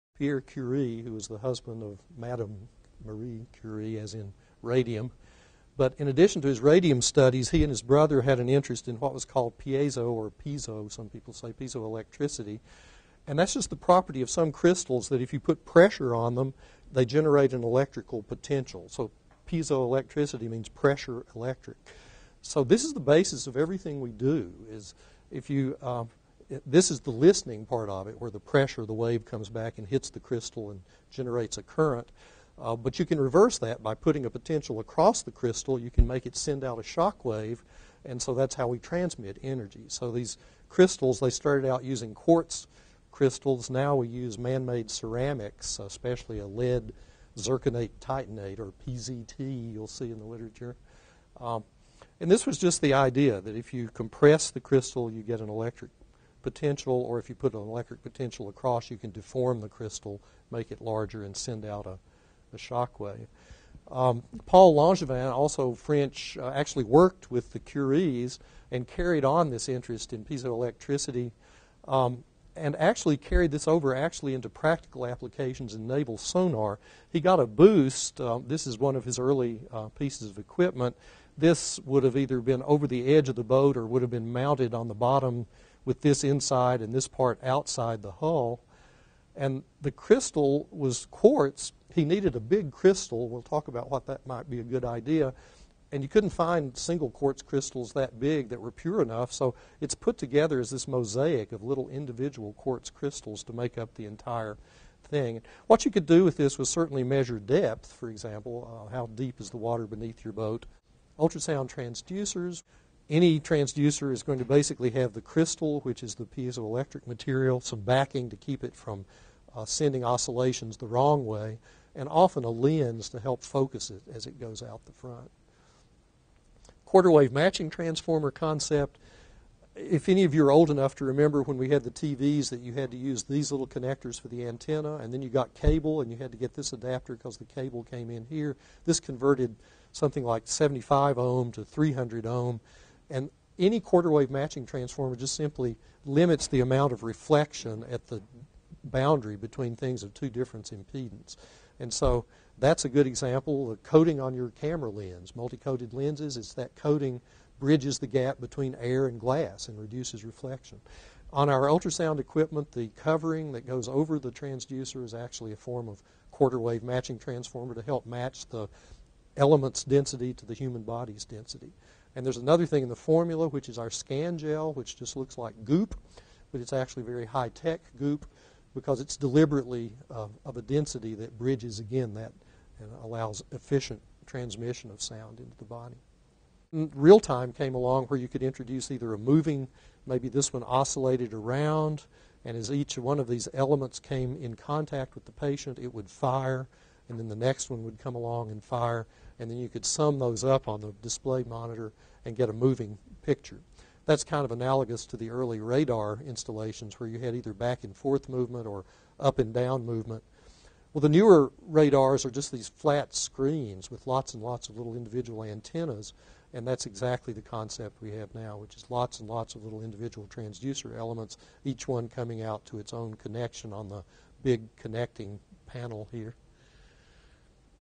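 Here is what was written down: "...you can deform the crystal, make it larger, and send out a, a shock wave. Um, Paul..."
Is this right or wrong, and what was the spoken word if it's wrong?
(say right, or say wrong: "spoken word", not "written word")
right.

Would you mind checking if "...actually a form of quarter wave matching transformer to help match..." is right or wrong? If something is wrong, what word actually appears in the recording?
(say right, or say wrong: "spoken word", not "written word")
right.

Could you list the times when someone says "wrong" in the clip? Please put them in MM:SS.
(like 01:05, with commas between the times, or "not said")
02:00.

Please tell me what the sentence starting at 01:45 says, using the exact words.
What you could do with this was certainly measure depth, for example, uh, how deep is the water beneath your boat.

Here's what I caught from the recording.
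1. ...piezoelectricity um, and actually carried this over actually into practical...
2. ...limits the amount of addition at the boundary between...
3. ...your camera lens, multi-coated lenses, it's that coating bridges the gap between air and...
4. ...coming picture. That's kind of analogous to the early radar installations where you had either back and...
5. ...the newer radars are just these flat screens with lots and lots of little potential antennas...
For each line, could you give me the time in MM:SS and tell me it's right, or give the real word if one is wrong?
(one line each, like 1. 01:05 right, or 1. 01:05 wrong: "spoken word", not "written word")
1. 01:10 right
2. 02:26 wrong: "reflection", not "addition"
3. 02:34 right
4. 03:22 wrong: "moving", not "coming"
5. 03:31 wrong: "individual", not "potential".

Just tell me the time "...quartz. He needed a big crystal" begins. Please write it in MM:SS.
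01:31.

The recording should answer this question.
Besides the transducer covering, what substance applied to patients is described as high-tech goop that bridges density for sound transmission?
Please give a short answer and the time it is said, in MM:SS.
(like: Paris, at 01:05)
scan gel, at 02:53.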